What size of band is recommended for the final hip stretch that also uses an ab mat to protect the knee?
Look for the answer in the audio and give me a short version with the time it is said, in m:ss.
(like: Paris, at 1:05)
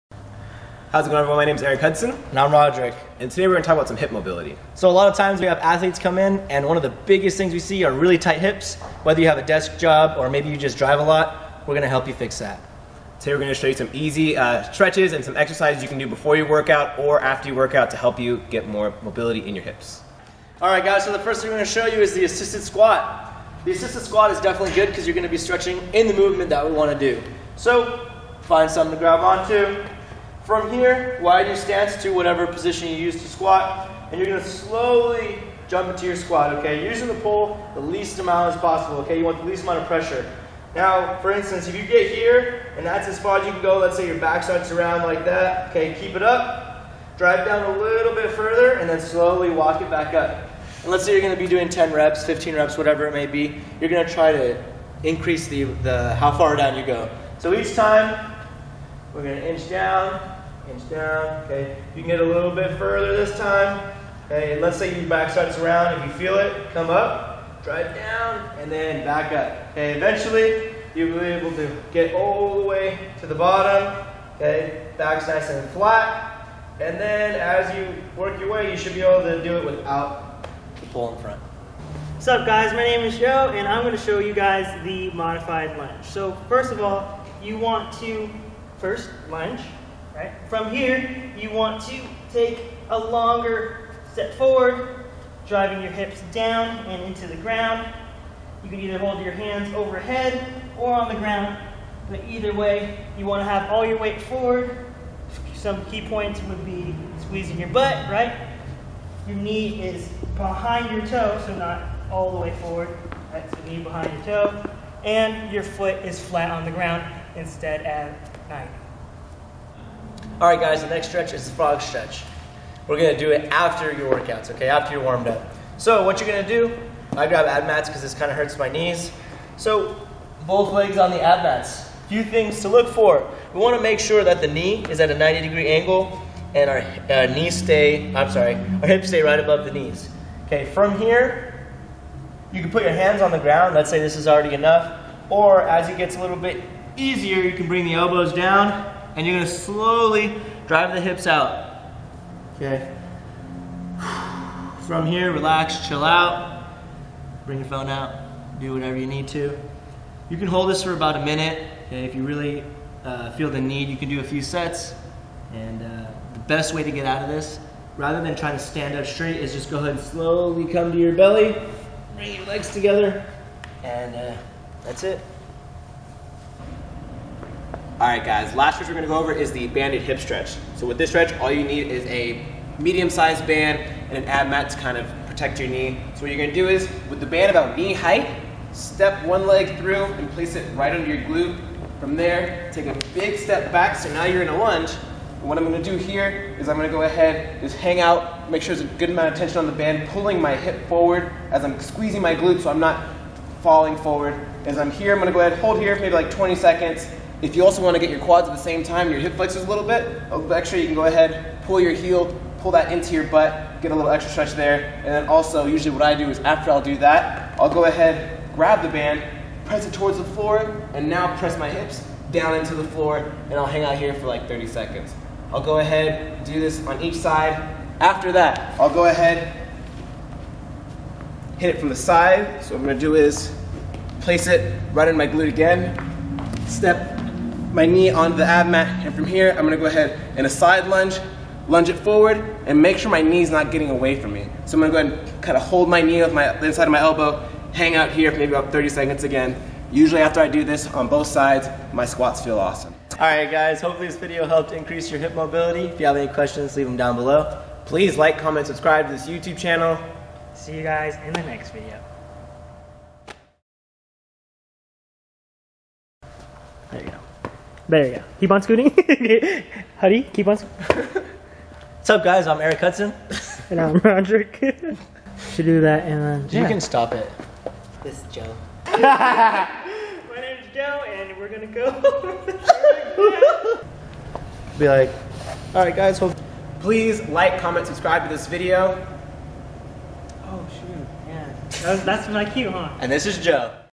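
Medium-sized, at 3:02.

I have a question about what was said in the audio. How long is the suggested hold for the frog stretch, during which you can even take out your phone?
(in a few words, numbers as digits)
About a minute.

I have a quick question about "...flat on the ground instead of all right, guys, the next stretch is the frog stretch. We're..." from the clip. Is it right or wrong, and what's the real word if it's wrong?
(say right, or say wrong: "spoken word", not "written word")
right.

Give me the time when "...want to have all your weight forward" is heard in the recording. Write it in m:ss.
1:43.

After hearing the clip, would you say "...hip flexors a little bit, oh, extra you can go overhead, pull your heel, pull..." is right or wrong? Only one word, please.
wrong.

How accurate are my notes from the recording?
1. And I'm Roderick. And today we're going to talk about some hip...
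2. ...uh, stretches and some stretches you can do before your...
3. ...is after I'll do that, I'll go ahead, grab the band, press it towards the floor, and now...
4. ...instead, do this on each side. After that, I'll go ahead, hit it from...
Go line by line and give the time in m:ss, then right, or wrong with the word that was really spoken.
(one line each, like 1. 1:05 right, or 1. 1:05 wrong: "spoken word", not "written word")
1. 0:02 right
2. 0:14 wrong: "exercises", not "stretches"
3. 3:36 right
4. 3:45 wrong: "ahead", not "instead".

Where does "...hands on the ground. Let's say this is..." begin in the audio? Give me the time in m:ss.
2:22.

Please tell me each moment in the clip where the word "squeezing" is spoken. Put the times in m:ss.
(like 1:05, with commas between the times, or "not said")
1:47, 3:21.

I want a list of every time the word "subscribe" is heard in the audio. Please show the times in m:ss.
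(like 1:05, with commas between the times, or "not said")
4:18, 4:47.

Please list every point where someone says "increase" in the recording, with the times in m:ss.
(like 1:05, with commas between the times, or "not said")
0:55, 4:14.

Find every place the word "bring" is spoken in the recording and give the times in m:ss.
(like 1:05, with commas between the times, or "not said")
2:27, 2:37, 2:52.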